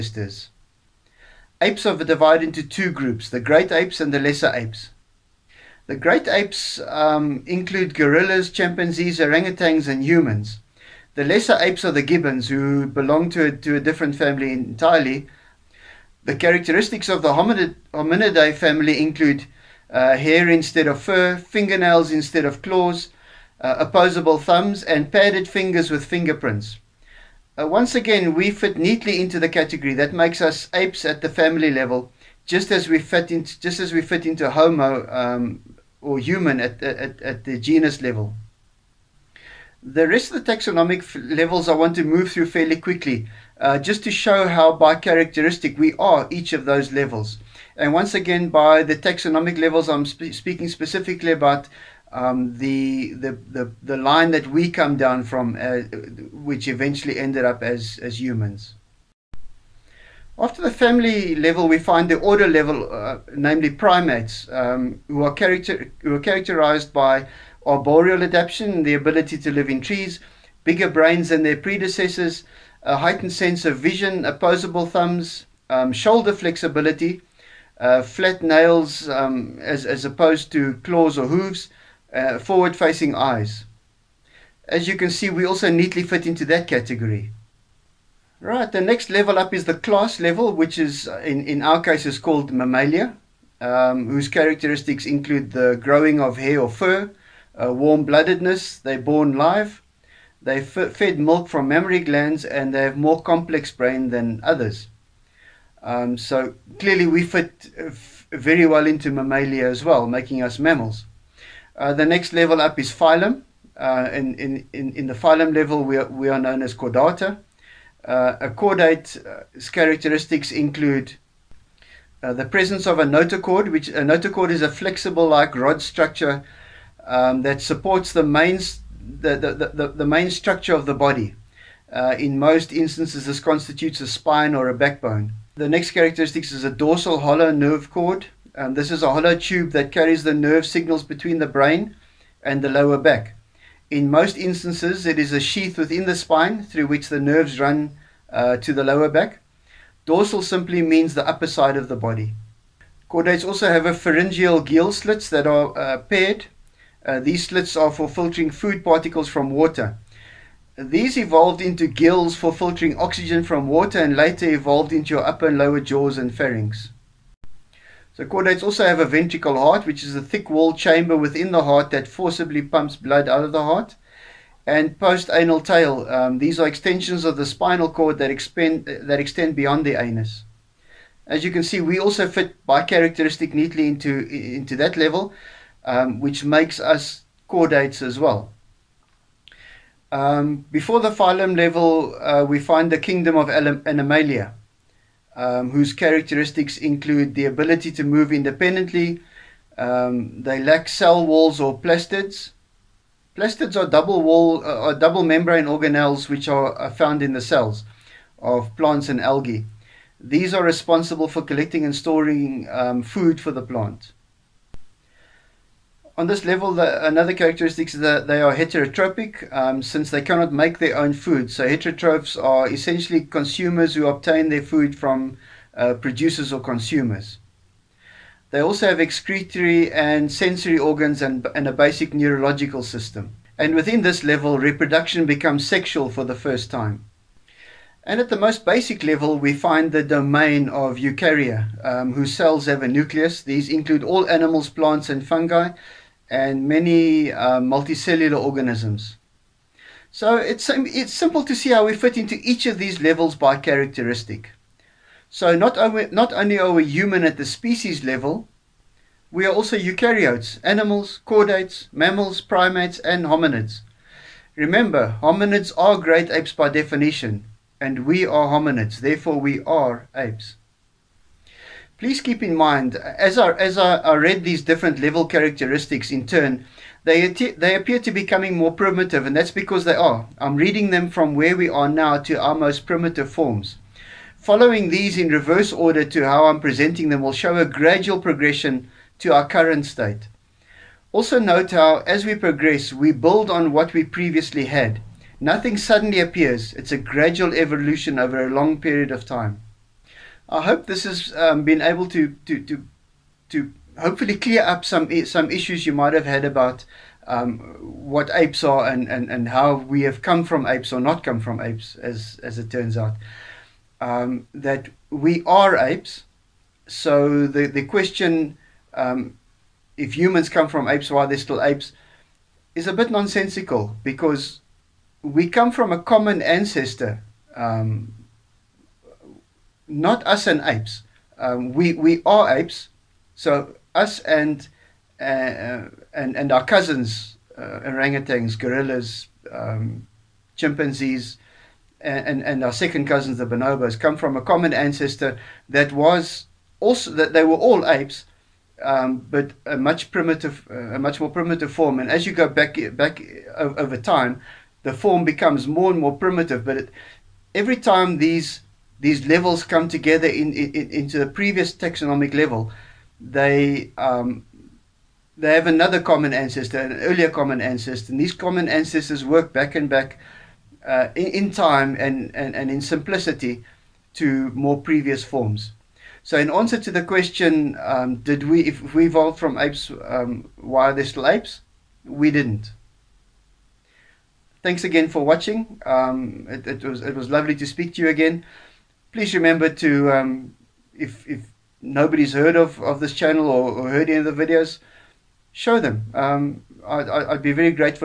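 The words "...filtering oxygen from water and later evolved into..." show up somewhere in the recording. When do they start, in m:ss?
2:42.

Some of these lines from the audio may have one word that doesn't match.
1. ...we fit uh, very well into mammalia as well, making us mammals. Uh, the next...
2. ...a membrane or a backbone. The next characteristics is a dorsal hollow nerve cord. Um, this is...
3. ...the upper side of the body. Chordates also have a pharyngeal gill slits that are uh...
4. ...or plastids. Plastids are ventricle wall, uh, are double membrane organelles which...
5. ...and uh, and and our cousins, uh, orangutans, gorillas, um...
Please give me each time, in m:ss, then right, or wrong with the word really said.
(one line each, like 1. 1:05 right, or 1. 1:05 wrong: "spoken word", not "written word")
1. 1:47 right
2. 2:14 wrong: "spine", not "membrane"
3. 2:31 right
4. 3:21 wrong: "double", not "ventricle"
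5. 5:34 right.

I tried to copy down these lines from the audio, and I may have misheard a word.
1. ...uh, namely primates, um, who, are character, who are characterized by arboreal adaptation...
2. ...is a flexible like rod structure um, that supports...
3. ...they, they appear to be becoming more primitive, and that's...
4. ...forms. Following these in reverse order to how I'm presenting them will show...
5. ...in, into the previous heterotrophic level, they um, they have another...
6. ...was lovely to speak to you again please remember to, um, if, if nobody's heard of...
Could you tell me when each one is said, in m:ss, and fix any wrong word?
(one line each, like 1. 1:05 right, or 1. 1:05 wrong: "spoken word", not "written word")
1. 1:02 right
2. 2:04 right
3. 4:37 right
4. 4:43 right
5. 6:00 wrong: "taxonomic", not "heterotrophic"
6. 6:27 right.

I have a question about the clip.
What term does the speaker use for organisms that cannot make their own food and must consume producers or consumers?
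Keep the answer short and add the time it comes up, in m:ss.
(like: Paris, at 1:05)
Heterotrophic, at 3:38.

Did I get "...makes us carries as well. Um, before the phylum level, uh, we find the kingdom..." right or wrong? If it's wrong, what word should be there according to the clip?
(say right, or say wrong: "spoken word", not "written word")
wrong: "chordates", not "carries".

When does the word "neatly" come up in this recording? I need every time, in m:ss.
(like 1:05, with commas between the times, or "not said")
0:28, 1:25, 3:03.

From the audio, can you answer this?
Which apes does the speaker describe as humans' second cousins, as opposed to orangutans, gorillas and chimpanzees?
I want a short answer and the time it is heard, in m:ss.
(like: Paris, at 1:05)
Bonobos, at 5:43.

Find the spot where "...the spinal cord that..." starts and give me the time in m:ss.
2:57.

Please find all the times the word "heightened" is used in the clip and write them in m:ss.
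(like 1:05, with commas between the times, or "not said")
1:12.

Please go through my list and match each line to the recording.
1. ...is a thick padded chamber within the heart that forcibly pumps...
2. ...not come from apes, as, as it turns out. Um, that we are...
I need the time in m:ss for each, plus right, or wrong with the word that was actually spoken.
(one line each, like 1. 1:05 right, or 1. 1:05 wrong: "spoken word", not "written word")
1. 2:50 wrong: "walled", not "padded"
2. 5:11 right.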